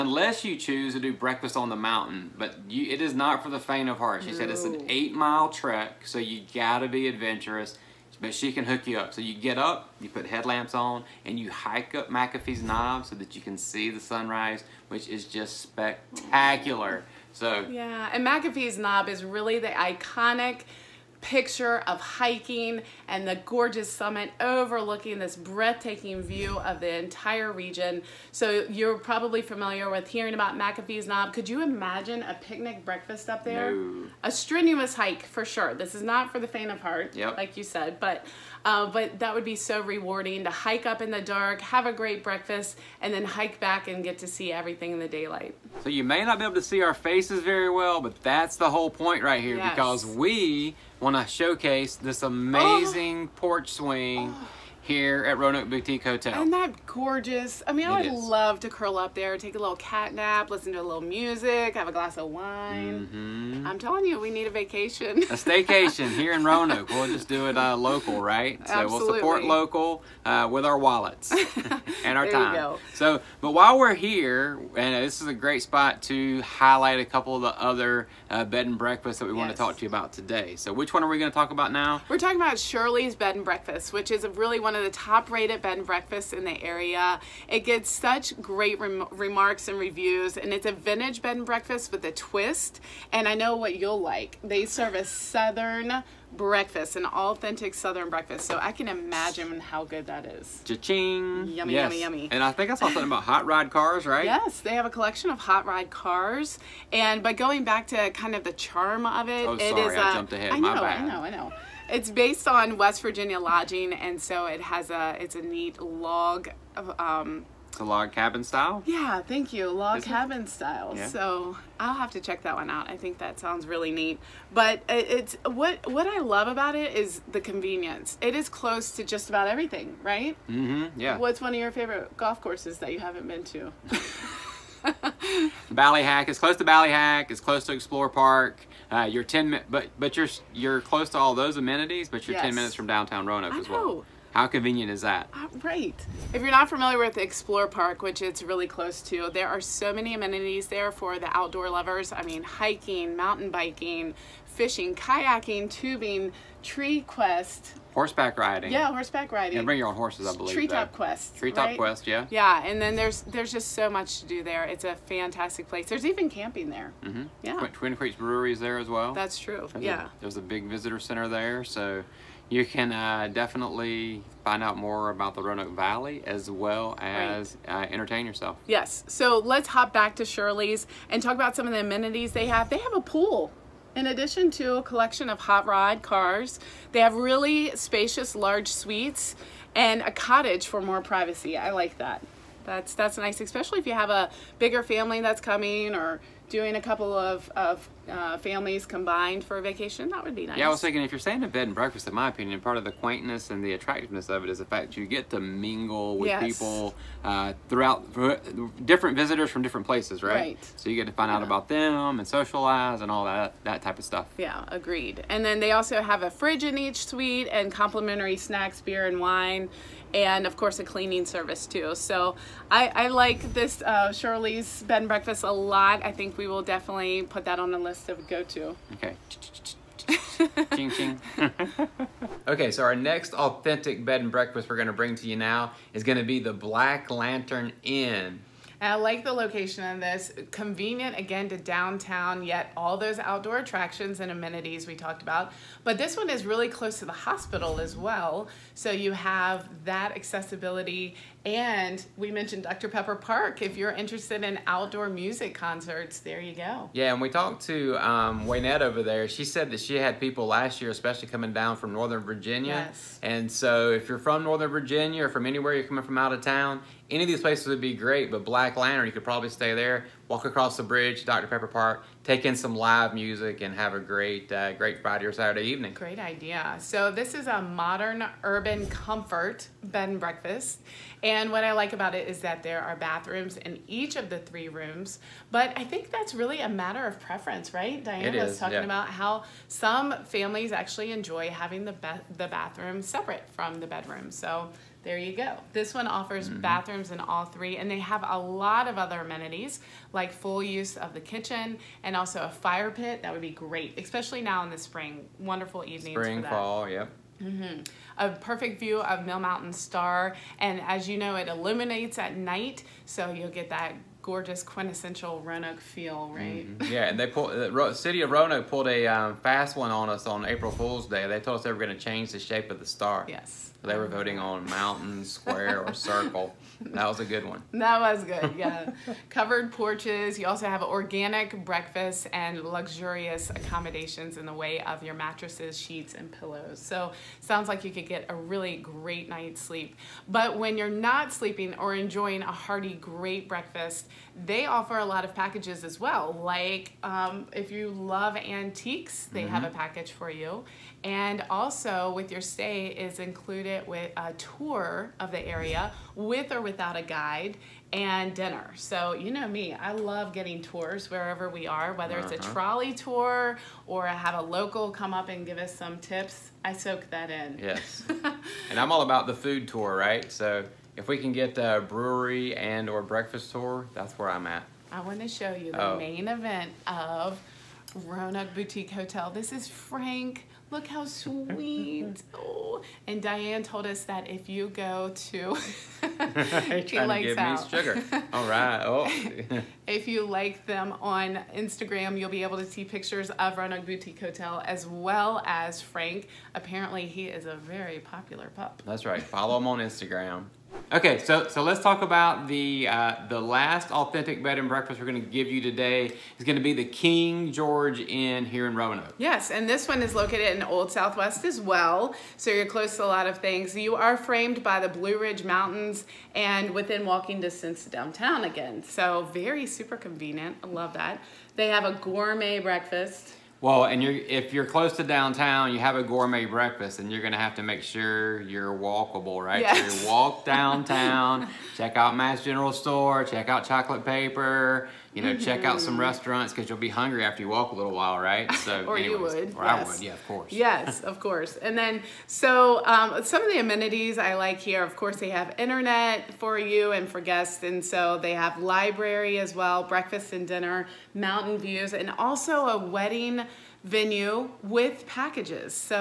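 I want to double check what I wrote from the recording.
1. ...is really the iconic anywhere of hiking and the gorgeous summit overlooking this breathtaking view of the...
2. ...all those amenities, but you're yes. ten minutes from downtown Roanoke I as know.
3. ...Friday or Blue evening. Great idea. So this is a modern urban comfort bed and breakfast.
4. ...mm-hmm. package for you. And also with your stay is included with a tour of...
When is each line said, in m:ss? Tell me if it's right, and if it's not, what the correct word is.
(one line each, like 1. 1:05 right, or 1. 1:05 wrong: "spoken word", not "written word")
1. 0:19 wrong: "picture", not "anywhere"
2. 2:21 right
3. 4:35 wrong: "Saturday", not "Blue"
4. 5:49 right.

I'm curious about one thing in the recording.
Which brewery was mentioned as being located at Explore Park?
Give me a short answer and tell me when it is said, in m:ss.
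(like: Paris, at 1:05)
Twin Creeks Brewery, at 2:47.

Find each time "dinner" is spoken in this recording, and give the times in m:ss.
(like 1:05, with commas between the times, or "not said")
5:58, 7:30.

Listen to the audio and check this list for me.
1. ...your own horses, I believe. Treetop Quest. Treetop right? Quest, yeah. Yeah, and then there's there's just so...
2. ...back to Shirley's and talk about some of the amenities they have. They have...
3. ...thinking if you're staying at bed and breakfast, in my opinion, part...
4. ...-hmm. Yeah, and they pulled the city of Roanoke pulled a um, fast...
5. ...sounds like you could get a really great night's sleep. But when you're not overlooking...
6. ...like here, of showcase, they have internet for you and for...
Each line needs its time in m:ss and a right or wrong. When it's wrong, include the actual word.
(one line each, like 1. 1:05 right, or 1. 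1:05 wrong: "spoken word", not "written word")
1. 2:39 right
2. 2:59 right
3. 3:20 right
4. 5:16 right
5. 5:37 wrong: "sleeping", not "overlooking"
6. 7:24 wrong: "course", not "showcase".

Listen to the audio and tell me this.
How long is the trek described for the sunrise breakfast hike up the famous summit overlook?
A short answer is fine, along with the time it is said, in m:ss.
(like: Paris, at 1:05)
8 miles, at 0:04.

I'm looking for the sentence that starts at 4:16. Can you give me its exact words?
Yeah, and we talked to um, Waynette over there.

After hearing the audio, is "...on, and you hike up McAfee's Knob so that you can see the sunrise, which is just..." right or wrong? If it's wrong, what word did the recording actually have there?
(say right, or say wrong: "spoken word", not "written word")
right.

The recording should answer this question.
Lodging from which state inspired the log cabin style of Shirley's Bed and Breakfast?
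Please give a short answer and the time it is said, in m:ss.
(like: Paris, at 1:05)
West Virginia, at 1:52.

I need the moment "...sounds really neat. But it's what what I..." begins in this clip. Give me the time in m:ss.
2:03.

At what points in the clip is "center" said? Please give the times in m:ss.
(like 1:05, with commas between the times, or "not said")
2:50.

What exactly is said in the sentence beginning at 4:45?
But I think that's really a matter of preference, right?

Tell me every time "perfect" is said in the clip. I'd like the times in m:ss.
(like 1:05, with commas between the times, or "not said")
5:08.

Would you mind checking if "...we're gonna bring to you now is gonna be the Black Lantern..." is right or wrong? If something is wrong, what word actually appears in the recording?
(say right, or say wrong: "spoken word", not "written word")
right.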